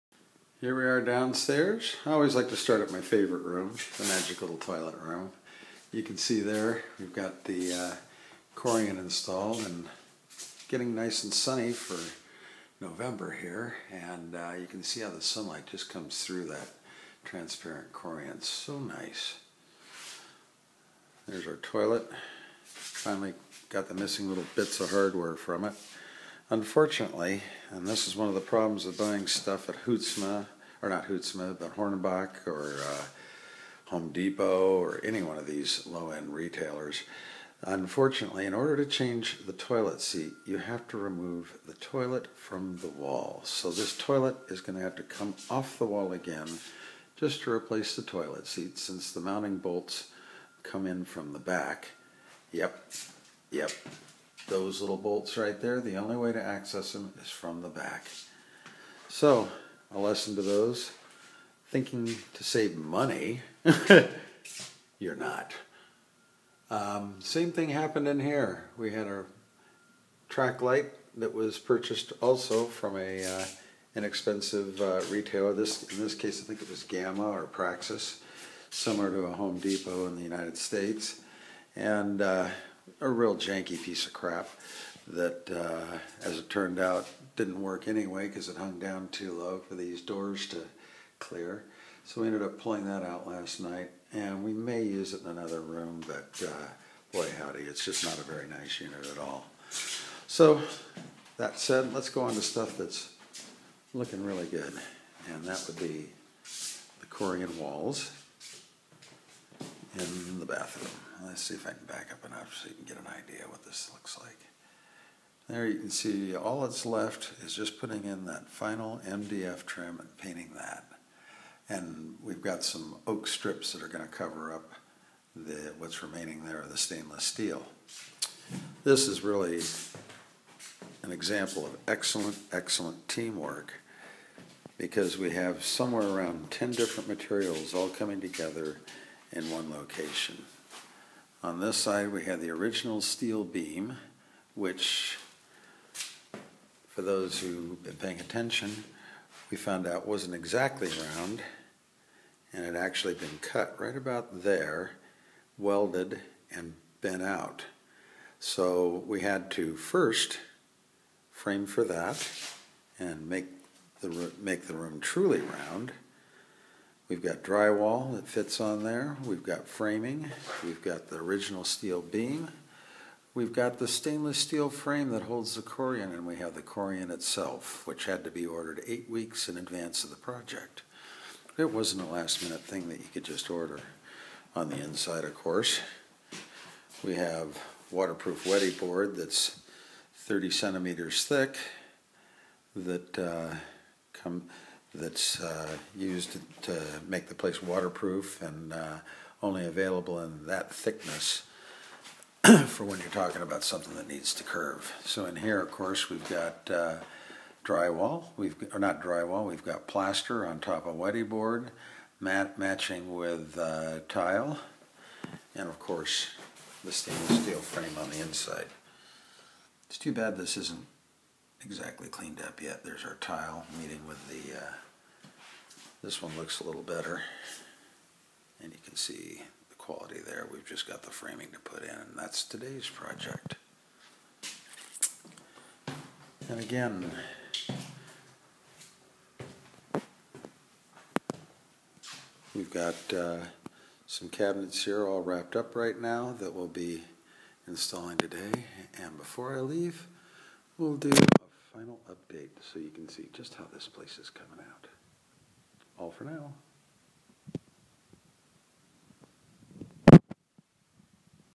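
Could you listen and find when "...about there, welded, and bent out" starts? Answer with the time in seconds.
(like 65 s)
153 s.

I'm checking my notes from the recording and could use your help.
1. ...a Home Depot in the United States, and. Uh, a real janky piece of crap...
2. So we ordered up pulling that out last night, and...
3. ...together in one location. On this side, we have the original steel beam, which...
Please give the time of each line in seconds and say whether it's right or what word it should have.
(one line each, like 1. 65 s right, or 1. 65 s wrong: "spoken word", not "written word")
1. 79 s right
2. 92 s wrong: "ended", not "ordered"
3. 138 s right.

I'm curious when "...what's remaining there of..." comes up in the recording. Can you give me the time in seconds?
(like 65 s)
125 s.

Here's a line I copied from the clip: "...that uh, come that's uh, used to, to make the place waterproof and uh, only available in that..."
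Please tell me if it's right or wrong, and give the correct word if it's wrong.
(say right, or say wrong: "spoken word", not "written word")
right.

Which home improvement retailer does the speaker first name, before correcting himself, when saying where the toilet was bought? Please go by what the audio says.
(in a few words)
Hornbach.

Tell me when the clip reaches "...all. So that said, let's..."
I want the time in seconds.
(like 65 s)
99 s.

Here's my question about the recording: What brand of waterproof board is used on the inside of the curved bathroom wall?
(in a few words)
Wedi.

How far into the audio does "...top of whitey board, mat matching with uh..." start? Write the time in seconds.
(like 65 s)
210 s.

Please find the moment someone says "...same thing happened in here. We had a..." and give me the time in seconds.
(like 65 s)
67 s.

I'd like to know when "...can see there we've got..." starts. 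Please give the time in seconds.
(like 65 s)
6 s.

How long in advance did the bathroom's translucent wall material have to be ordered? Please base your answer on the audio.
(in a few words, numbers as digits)
8 weeks.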